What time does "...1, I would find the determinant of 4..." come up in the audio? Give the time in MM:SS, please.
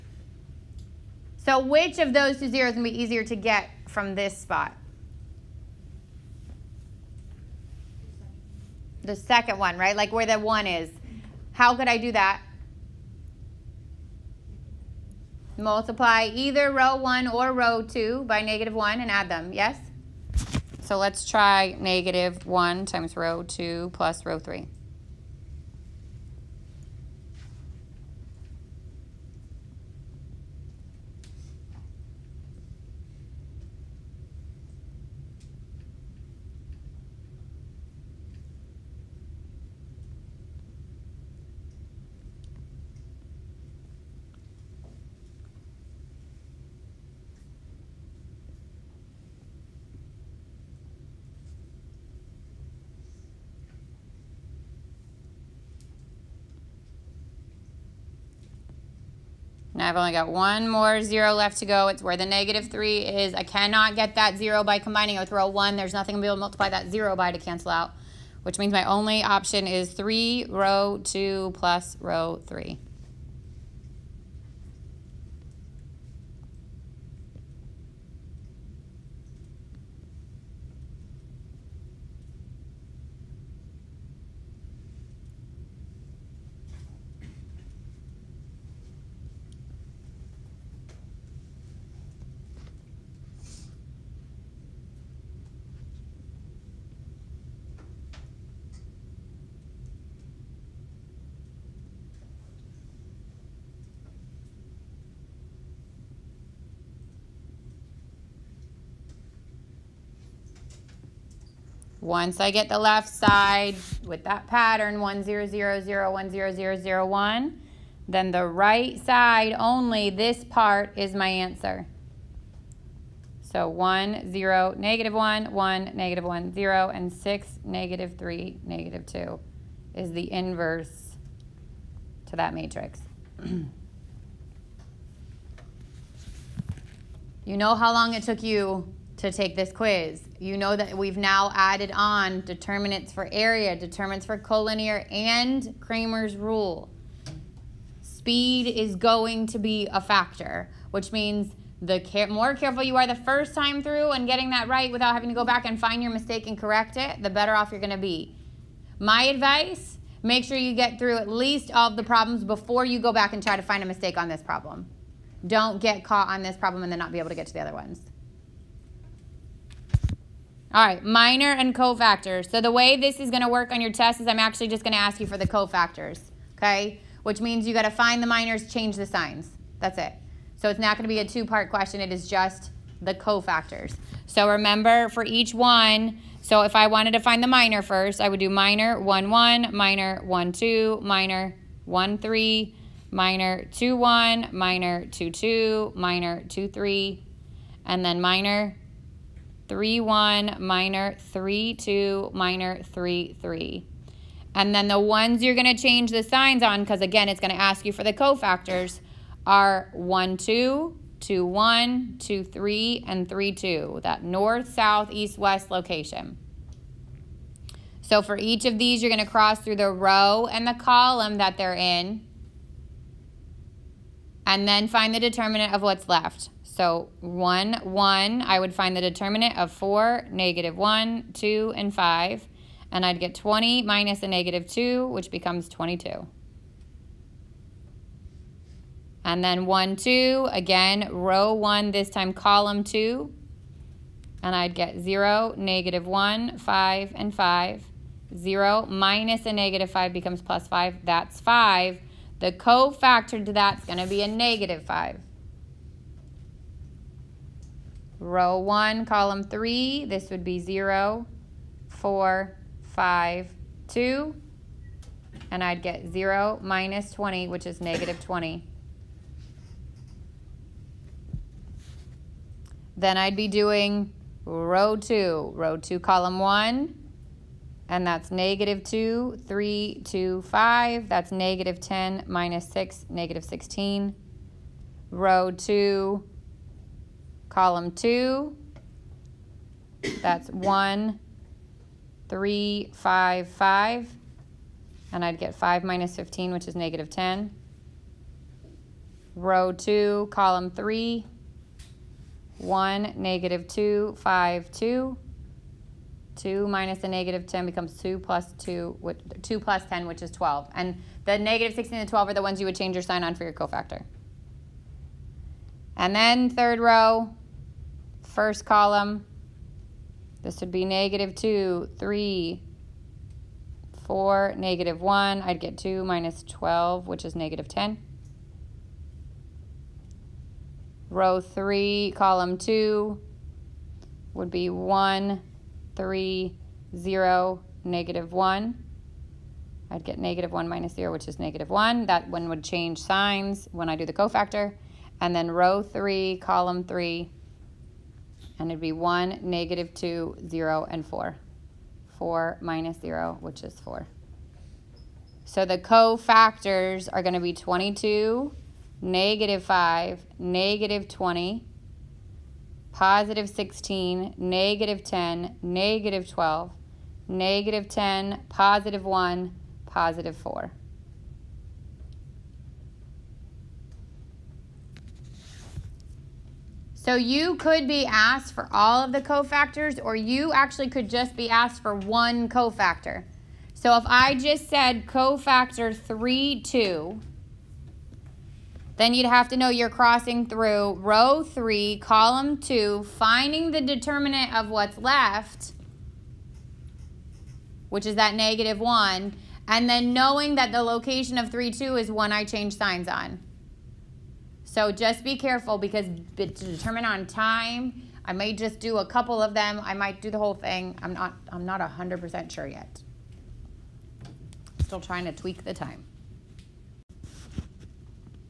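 03:47.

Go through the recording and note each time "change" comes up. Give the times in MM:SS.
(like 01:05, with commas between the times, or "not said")
02:58, 03:25, 05:12, 05:42, 06:42.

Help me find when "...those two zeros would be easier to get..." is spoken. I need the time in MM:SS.
00:02.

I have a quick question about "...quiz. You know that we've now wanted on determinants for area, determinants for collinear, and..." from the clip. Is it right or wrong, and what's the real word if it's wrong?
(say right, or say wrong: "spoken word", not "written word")
wrong: "added", not "wanted".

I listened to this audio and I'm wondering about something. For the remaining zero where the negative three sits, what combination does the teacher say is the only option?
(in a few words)
3 row 2 plus row 3.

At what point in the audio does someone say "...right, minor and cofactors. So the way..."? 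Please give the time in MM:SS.
02:50.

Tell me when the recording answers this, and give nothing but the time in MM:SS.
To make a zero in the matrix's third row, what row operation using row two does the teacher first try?
00:21.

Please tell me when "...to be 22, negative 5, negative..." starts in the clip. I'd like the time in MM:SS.
05:57.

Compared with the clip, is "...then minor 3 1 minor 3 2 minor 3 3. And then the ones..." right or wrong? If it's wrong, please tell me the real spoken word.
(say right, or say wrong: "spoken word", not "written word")
right.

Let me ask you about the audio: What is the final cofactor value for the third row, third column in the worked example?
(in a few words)
4.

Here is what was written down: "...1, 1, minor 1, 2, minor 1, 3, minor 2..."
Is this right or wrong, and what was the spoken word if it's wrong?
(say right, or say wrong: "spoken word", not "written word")
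right.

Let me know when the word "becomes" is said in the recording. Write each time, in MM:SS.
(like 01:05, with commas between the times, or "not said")
03:55, 04:10, 05:07.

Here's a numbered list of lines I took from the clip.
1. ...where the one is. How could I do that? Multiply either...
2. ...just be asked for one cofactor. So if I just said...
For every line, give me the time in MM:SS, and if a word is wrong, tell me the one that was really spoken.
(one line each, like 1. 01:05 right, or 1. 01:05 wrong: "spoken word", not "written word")
1. 00:10 right
2. 06:21 right.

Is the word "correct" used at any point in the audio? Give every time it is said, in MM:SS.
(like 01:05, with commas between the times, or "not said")
02:36.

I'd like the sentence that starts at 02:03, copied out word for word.
So 1, 0, negative 1, 1, negative 1, 0, and 6, negative 3, negative 2 is the inverse to that matrix.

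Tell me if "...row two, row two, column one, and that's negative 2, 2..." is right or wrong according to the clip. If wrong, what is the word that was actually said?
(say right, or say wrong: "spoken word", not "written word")
wrong: "3", not "2".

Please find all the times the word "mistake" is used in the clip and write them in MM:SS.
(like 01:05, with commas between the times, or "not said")
02:36, 02:43.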